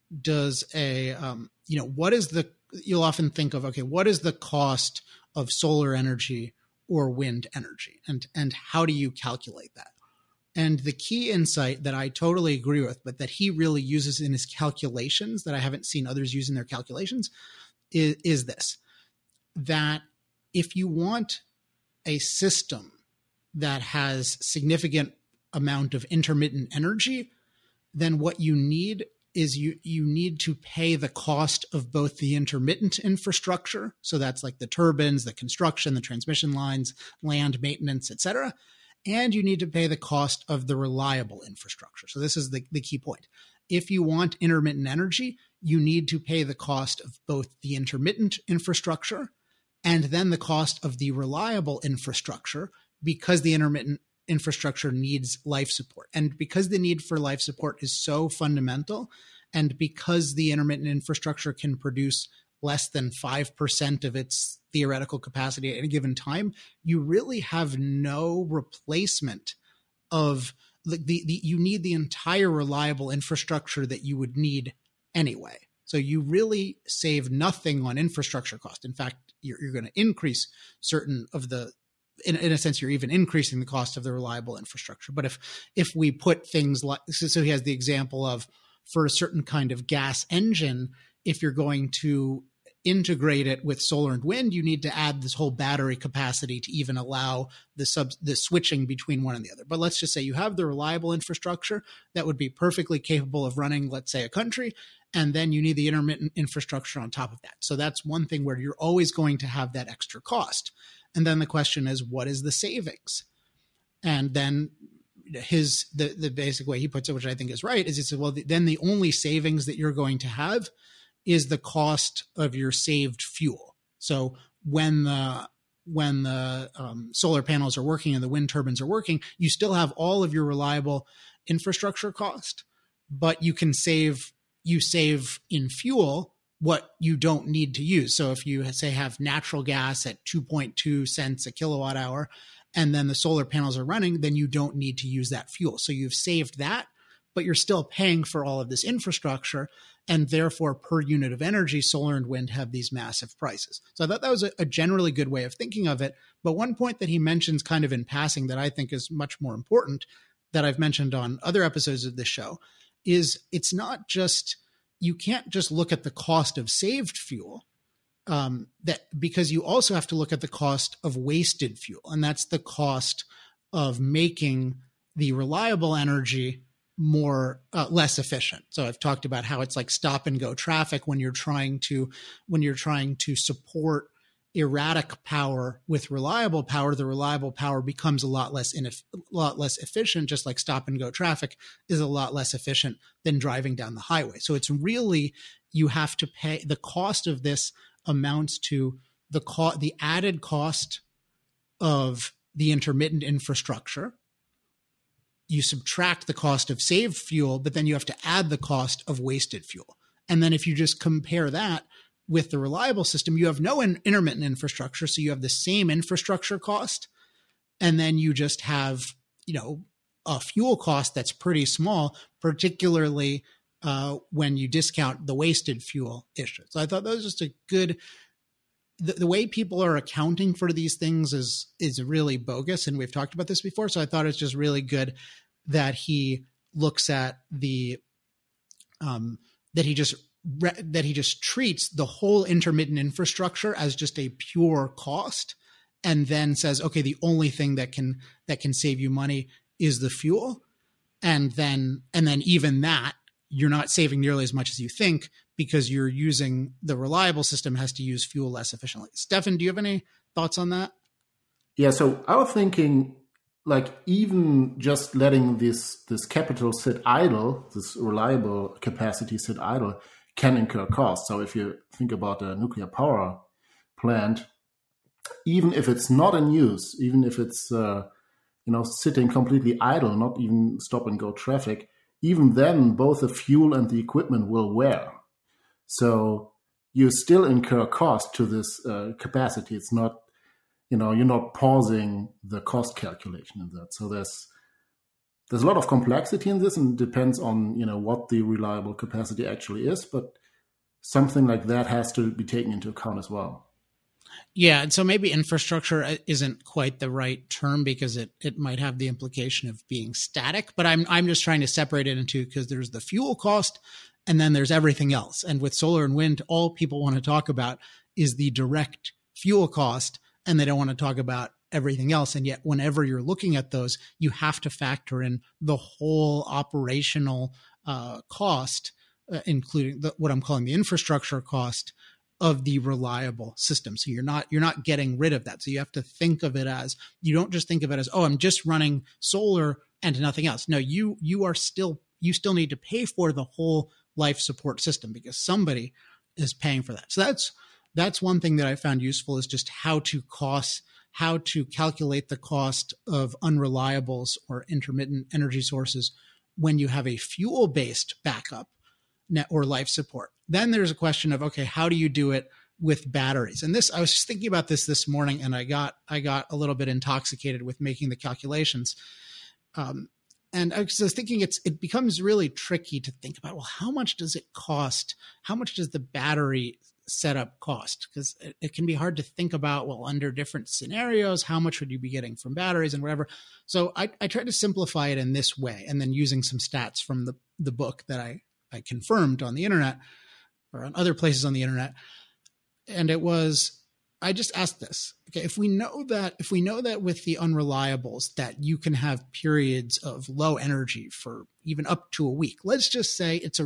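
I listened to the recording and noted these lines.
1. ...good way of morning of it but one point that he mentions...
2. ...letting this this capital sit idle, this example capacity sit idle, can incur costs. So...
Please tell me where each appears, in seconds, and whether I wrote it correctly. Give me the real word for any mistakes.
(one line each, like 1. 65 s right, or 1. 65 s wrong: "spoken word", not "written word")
1. 155 s wrong: "thinking", not "morning"
2. 265 s wrong: "reliable", not "example".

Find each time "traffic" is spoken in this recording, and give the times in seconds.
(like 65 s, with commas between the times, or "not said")
180 s, 191 s, 281 s.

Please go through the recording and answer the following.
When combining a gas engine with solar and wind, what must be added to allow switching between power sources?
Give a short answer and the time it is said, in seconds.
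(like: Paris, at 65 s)
battery capacity, at 95 s.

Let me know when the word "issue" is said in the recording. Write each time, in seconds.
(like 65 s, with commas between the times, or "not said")
226 s.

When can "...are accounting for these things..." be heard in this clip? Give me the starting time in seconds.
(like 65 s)
229 s.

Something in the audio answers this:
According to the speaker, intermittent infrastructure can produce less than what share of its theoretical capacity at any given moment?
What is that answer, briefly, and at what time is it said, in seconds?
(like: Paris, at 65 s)
5%, at 63 s.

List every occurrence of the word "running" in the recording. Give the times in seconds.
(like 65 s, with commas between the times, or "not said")
103 s, 143 s, 338 s.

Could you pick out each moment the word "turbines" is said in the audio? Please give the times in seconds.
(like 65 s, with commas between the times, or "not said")
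34 s, 128 s.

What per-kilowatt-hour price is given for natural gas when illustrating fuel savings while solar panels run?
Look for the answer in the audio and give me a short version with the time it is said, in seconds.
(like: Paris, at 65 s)
2.2 cents, at 140 s.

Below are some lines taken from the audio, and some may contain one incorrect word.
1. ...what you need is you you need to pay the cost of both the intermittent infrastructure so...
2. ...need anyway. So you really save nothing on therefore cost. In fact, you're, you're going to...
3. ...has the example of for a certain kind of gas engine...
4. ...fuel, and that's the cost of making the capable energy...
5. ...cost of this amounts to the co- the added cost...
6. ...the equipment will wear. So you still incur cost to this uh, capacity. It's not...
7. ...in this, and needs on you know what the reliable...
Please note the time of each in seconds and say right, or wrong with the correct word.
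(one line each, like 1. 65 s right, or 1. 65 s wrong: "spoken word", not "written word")
1. 28 s right
2. 74 s wrong: "infrastructure", not "therefore"
3. 87 s right
4. 171 s wrong: "reliable", not "capable"
5. 196 s right
6. 283 s right
7. 296 s wrong: "depends", not "needs".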